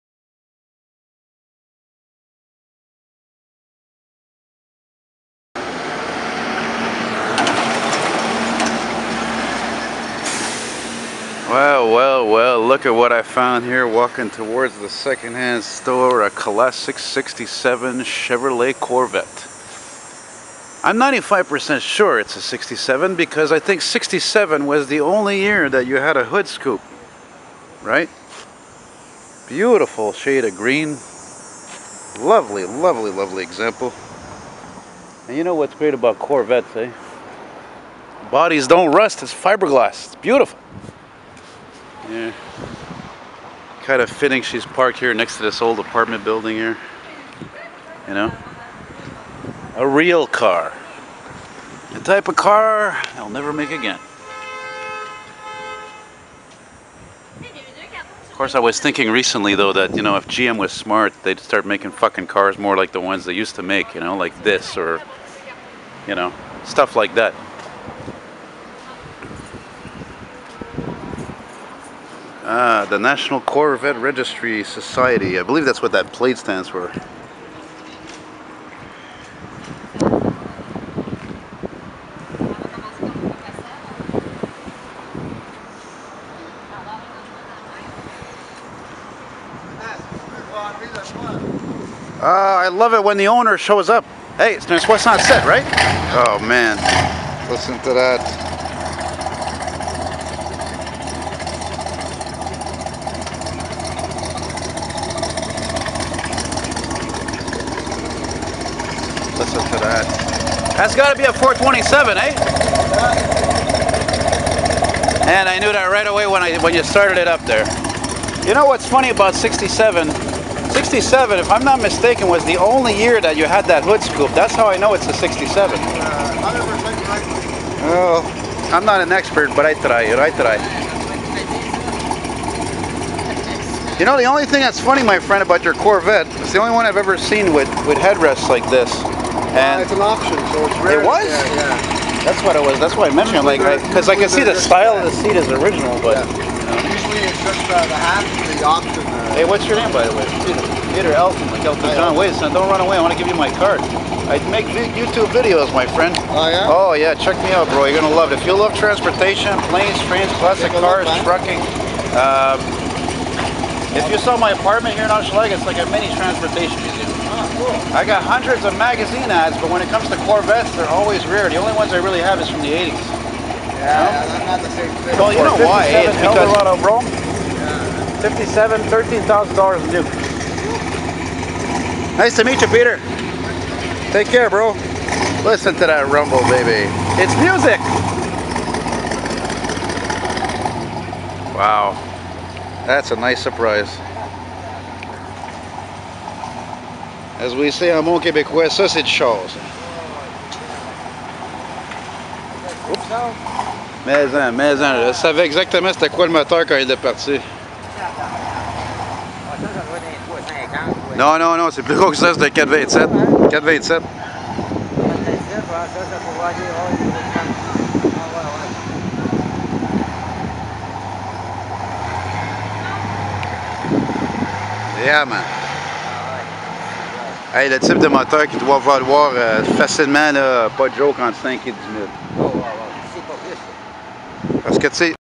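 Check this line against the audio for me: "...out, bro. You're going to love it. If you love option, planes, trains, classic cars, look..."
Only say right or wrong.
wrong.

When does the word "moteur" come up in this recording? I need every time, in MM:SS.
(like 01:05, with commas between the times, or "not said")
03:26, 03:48.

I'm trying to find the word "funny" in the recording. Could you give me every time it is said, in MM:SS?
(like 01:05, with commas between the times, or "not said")
01:58, 02:14.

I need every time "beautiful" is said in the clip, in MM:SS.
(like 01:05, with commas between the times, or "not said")
00:29, 00:40.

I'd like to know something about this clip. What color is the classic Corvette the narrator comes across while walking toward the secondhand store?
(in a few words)
Green.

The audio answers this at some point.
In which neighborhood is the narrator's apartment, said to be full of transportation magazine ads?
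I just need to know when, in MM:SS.
02:45.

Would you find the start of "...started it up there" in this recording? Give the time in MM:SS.
01:56.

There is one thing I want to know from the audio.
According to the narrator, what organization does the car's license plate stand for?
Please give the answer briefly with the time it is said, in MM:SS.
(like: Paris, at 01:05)
National Corvette Registry Society, at 01:12.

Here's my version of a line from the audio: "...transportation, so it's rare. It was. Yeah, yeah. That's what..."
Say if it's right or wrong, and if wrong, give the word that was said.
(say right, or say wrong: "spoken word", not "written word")
wrong: "option", not "transportation".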